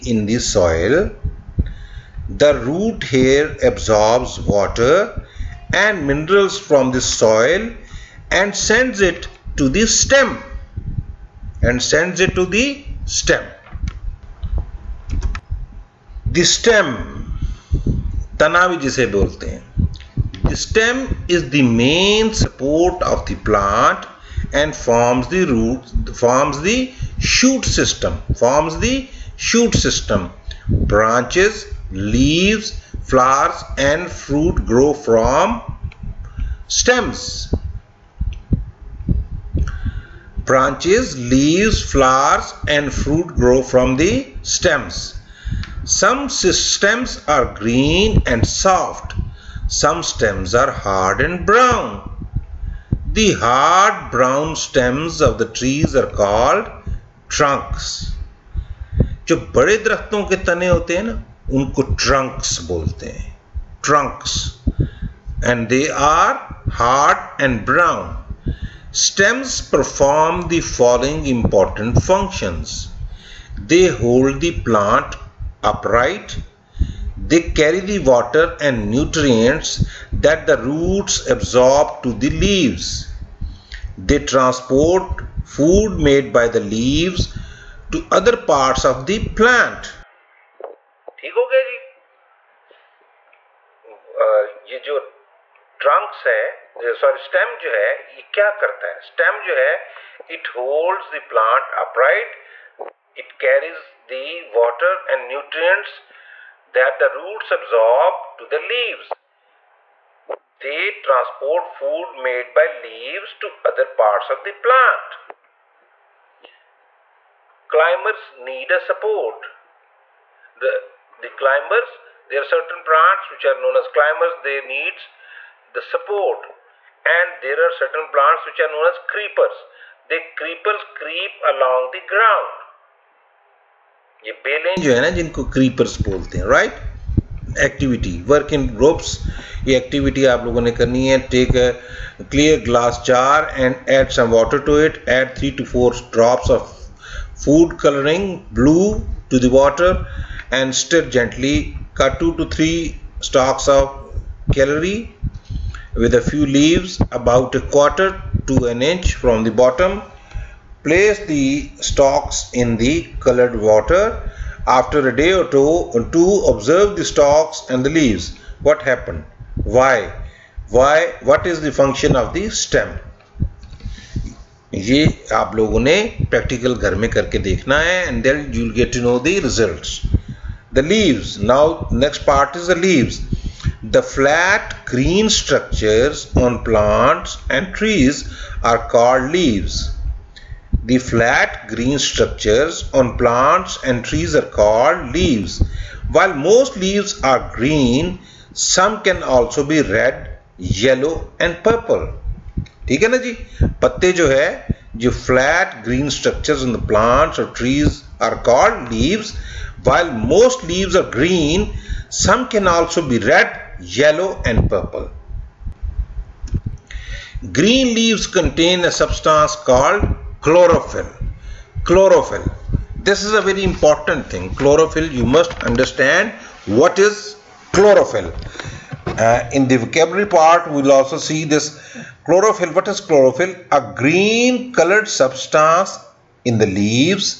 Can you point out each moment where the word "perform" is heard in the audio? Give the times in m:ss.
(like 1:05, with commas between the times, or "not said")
1:09.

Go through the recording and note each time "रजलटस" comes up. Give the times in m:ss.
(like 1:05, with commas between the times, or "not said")
2:59.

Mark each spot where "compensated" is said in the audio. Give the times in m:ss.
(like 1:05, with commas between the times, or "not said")
not said.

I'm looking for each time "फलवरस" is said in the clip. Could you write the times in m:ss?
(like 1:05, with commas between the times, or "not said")
0:33, 0:41.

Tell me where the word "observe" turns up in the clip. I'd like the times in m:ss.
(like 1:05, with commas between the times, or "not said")
2:46.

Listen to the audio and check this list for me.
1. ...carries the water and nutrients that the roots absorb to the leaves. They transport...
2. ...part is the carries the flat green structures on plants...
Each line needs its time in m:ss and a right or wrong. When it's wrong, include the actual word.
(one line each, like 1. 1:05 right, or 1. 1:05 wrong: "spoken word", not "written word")
1. 1:43 right
2. 3:02 wrong: "leaves", not "carries".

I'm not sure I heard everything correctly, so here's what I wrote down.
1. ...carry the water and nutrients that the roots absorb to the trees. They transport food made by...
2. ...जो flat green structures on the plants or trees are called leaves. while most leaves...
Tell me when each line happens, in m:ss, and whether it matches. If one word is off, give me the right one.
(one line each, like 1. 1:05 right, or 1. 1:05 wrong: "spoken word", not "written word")
1. 1:17 wrong: "leaves", not "trees"
2. 3:25 right.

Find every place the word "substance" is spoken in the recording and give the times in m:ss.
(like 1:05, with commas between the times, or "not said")
3:38, 3:55.